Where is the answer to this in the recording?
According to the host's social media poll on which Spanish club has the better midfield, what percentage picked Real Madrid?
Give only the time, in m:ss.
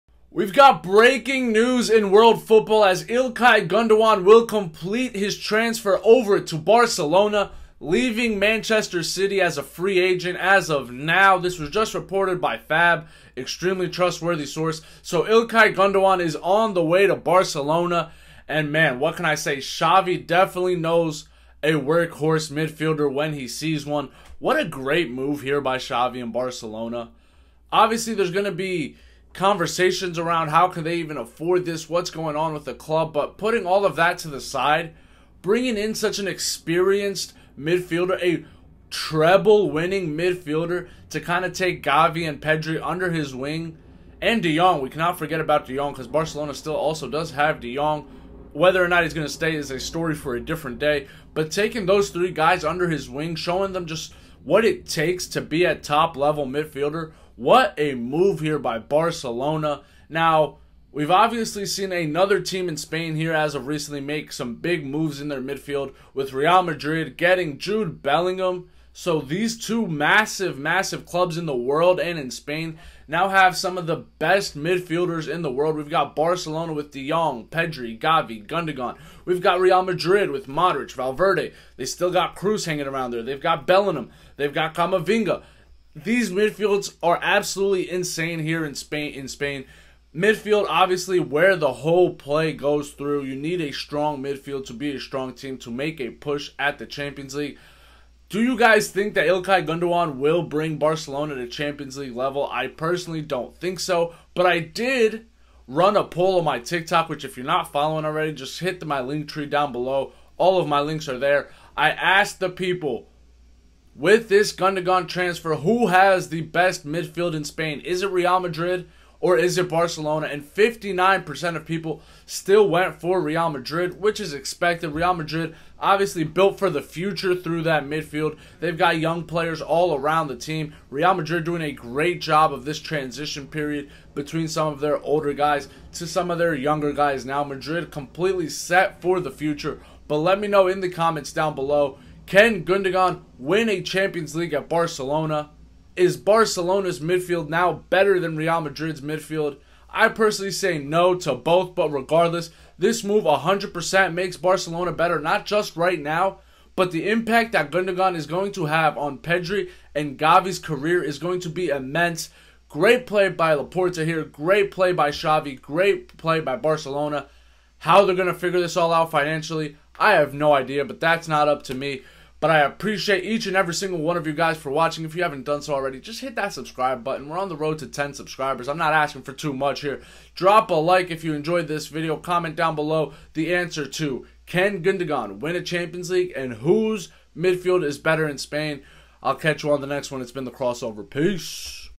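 2:00.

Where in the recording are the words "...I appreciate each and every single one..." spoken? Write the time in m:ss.
2:52.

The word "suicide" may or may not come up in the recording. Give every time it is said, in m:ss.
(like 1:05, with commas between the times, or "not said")
not said.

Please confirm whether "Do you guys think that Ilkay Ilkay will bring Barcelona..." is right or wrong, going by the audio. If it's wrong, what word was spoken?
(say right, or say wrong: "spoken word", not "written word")
wrong: "Gundogan", not "Ilkay".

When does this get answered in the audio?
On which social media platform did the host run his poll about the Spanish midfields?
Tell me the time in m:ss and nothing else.
1:46.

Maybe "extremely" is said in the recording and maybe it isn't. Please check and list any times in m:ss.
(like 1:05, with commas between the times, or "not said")
0:13.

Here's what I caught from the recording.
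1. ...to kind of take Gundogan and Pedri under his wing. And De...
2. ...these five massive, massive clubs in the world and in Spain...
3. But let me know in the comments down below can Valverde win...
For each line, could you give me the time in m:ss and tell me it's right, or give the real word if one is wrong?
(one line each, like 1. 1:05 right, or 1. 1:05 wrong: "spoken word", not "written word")
1. 0:41 wrong: "Gavi", not "Gundogan"
2. 1:09 wrong: "two", not "five"
3. 2:20 wrong: "Gundogan", not "Valverde".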